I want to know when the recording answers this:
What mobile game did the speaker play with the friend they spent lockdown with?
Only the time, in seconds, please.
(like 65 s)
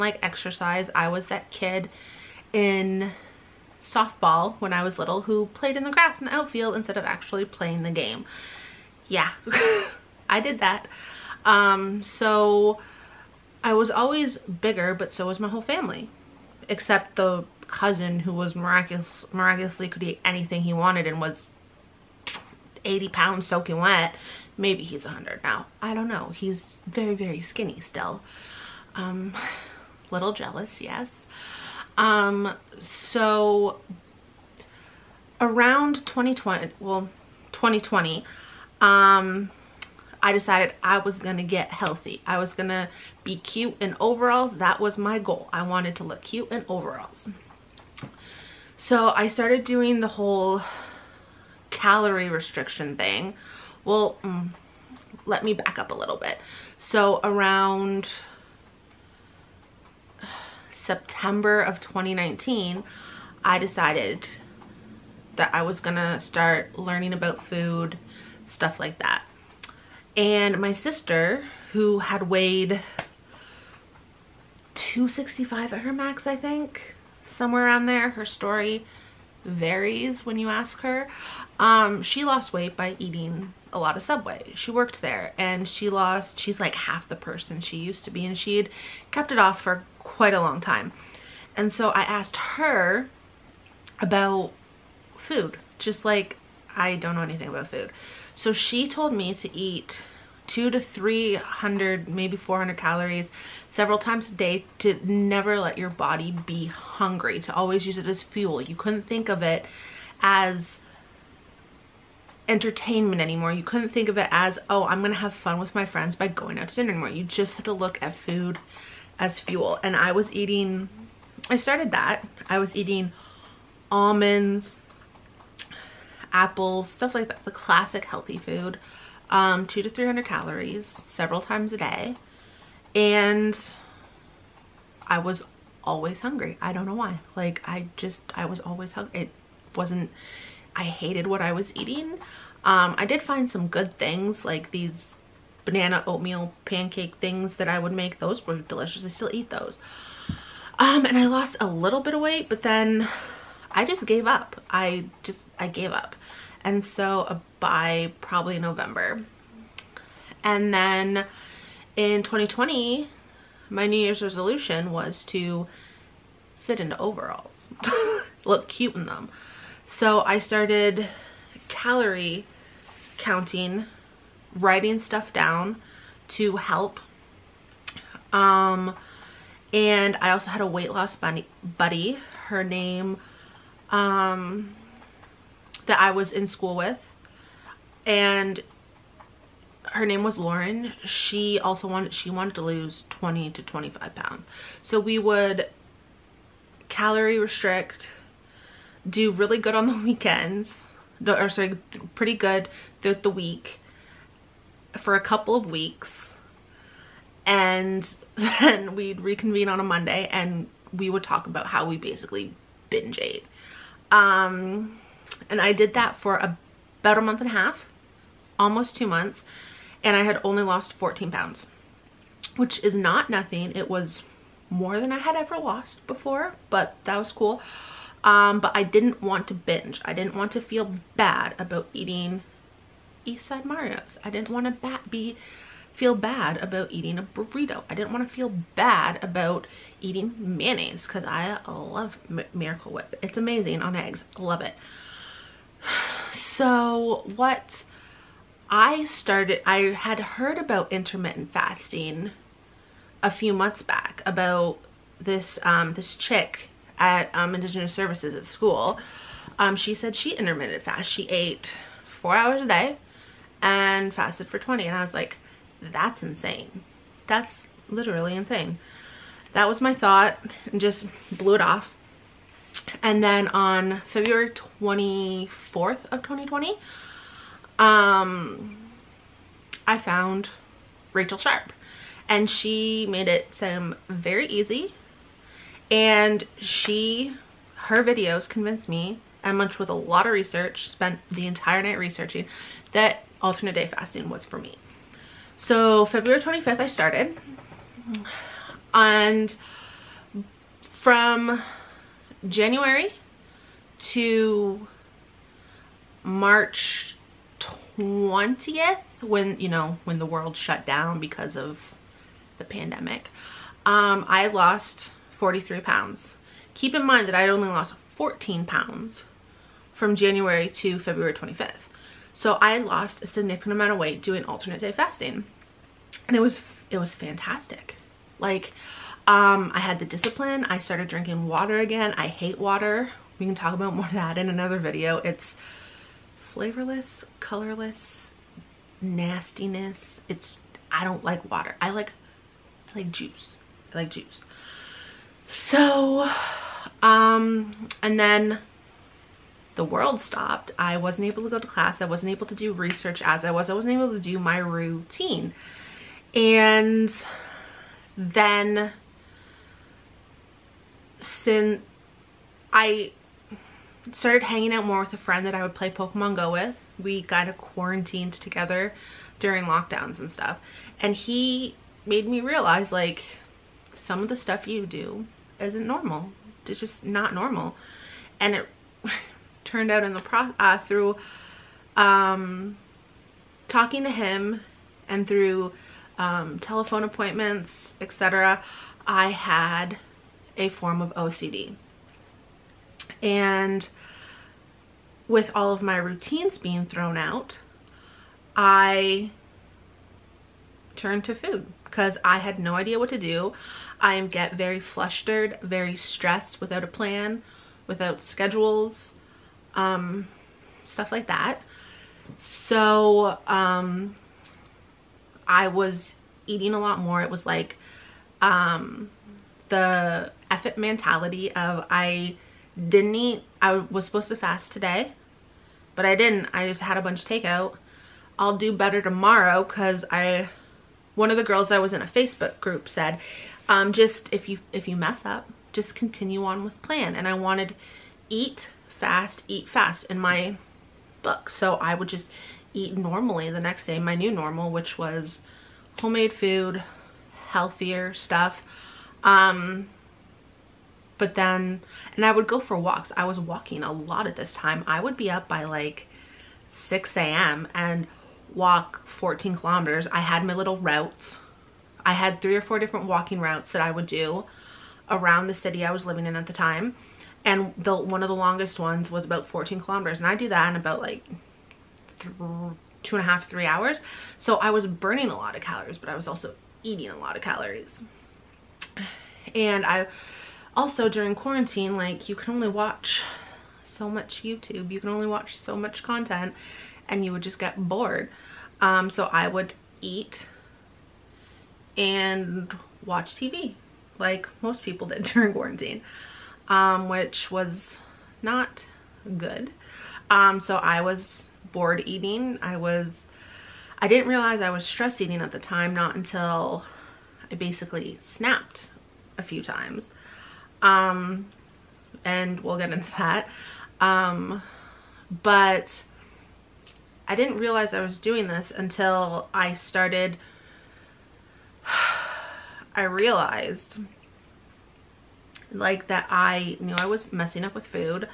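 365 s.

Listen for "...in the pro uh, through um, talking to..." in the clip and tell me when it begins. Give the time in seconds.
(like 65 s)
380 s.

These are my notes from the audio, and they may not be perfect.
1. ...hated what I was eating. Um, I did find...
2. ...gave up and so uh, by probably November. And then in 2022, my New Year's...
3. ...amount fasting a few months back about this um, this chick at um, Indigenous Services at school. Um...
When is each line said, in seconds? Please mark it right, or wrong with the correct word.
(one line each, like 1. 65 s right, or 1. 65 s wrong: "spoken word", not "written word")
1. 140 s right
2. 155 s wrong: "2020", not "2022"
3. 250 s wrong: "intermittent", not "amount".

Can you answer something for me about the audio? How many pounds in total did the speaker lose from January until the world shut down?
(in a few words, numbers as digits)
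43 pounds.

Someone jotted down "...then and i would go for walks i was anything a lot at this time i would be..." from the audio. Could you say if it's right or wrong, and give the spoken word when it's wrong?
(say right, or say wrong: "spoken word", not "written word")
wrong: "walking", not "anything".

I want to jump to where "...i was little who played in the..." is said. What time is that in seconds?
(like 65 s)
4 s.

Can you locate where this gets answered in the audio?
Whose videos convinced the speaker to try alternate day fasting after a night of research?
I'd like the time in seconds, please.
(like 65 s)
281 s.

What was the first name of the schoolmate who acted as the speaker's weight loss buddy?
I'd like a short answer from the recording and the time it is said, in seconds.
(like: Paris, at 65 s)
Lauren, at 190 s.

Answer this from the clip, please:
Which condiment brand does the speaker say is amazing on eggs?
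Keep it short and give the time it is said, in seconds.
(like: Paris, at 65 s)
Miracle Whip, at 242 s.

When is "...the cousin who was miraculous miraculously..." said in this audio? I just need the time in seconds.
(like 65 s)
17 s.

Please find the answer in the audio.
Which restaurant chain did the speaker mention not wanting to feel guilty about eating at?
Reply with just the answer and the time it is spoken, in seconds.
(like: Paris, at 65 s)
Eastside Mario's, at 233 s.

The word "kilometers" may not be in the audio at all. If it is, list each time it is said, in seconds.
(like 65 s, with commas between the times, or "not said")
459 s, 469 s.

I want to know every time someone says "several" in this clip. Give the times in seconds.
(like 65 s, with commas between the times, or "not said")
103 s, 131 s.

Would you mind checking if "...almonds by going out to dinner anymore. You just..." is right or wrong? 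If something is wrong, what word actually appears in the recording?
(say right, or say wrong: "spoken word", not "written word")
wrong: "friends", not "almonds".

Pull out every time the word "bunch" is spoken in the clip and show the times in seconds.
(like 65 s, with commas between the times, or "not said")
427 s.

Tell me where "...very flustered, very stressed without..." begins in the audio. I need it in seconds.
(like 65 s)
404 s.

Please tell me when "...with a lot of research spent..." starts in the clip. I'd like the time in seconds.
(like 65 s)
289 s.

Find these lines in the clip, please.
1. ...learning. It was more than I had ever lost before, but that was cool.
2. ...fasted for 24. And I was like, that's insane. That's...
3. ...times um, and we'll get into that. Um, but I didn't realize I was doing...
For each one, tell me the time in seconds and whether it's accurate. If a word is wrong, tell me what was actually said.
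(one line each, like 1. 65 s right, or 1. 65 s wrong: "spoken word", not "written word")
1. 223 s wrong: "nothing", not "learning"
2. 264 s wrong: "20", not "24"
3. 509 s right.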